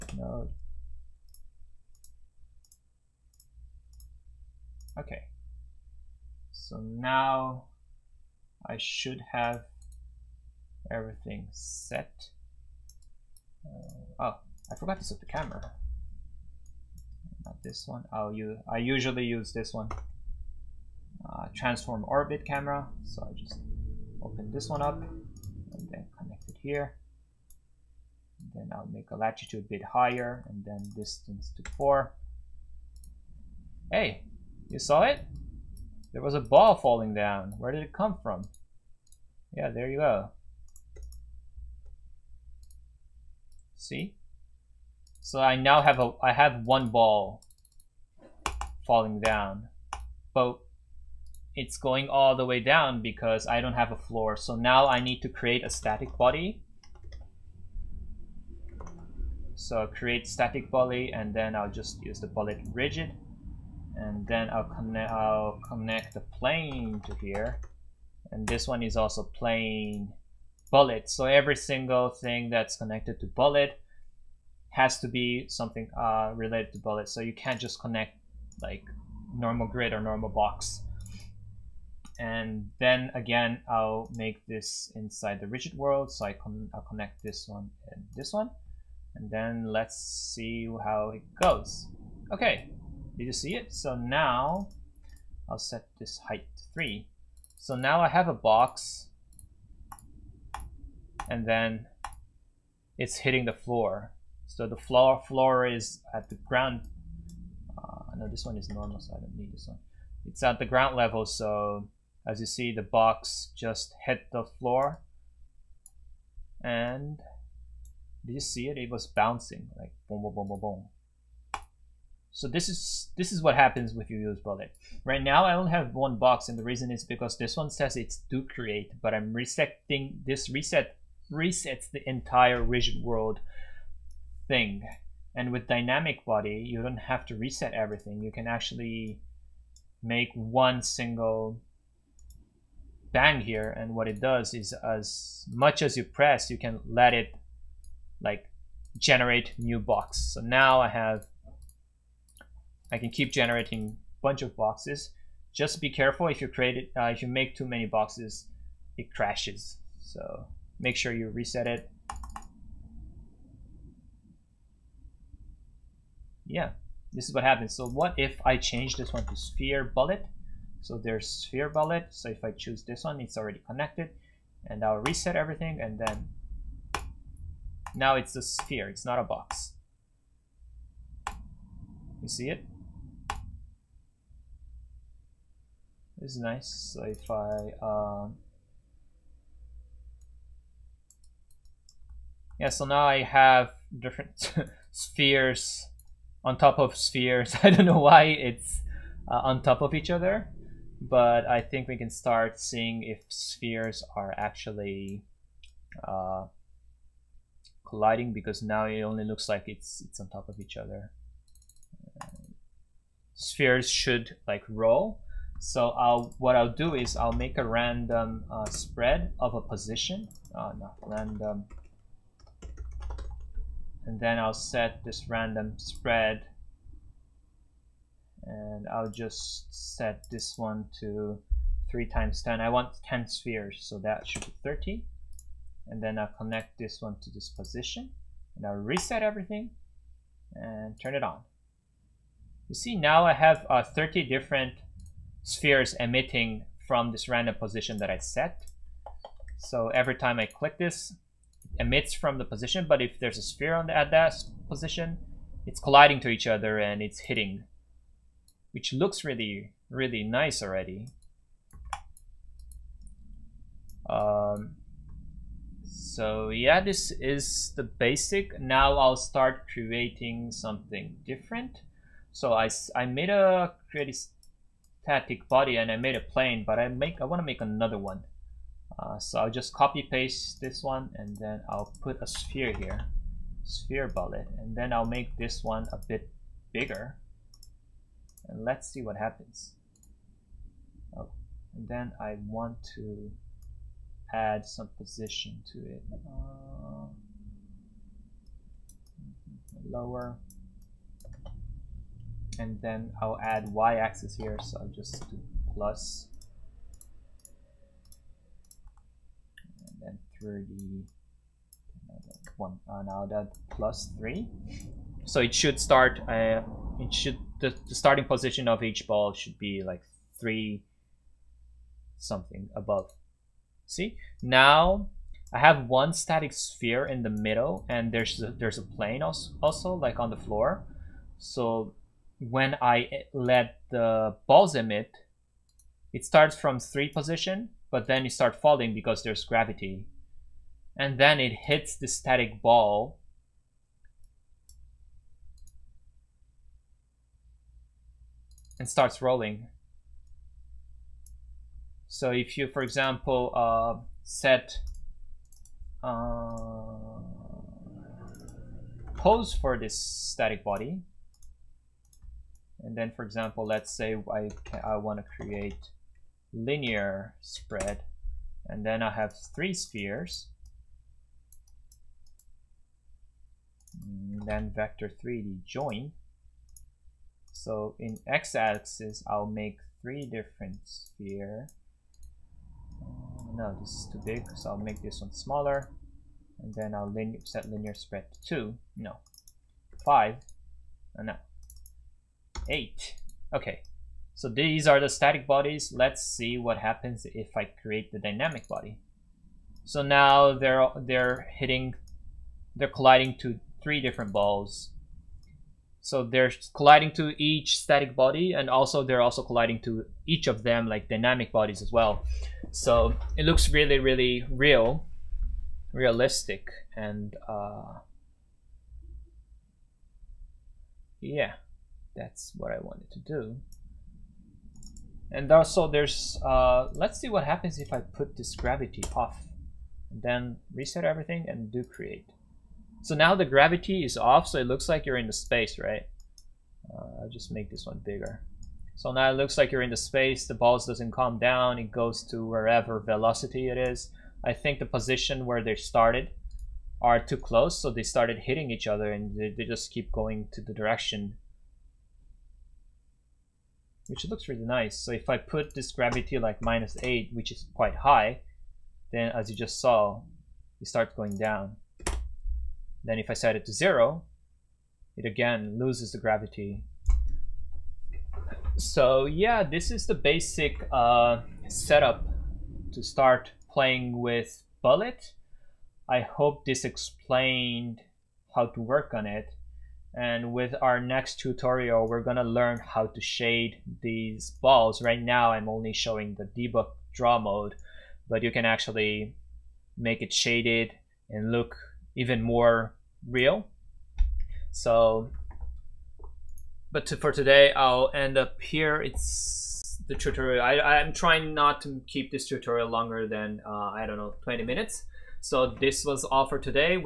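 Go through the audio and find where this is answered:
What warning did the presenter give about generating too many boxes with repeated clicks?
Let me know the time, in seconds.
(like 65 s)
158 s.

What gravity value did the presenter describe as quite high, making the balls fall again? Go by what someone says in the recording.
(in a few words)
-8.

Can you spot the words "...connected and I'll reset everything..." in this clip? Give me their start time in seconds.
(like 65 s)
173 s.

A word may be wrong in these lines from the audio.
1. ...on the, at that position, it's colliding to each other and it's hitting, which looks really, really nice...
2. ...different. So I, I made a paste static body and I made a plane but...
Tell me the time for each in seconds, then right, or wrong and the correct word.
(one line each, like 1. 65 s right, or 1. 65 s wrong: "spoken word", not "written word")
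1. 253 s right
2. 271 s wrong: "create", not "paste".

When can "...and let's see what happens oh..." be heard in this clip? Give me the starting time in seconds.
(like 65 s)
288 s.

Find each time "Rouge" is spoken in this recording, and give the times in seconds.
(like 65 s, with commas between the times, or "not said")
not said.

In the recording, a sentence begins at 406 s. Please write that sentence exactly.
So they're colliding to each static body, and also they're also colliding to each of them like dynamic bodies as well.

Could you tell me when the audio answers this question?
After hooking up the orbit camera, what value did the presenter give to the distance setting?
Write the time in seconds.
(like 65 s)
30 s.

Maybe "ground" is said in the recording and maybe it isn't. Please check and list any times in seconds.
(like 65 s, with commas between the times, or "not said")
106 s, 110 s.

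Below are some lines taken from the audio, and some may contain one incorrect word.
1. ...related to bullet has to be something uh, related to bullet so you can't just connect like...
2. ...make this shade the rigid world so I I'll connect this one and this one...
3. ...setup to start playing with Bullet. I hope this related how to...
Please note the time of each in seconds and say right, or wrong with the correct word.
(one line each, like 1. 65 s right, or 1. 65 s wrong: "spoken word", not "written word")
1. 72 s wrong: "connected", not "related"
2. 84 s wrong: "inside", not "shade"
3. 471 s wrong: "explained", not "related".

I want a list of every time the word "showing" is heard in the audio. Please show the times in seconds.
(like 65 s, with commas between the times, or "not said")
485 s.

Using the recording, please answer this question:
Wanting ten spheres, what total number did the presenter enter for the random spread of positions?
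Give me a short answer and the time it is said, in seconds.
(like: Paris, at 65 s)
30, at 233 s.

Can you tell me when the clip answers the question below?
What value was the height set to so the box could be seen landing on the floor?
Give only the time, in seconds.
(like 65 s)
95 s.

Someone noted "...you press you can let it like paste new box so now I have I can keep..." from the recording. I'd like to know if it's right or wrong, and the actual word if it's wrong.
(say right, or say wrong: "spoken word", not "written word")
wrong: "generate", not "paste".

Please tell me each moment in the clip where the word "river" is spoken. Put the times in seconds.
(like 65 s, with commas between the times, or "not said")
not said.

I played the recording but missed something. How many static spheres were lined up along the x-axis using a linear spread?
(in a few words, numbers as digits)
3.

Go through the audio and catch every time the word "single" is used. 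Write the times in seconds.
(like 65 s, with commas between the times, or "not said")
71 s, 140 s.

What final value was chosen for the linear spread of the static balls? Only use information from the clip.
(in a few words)
8.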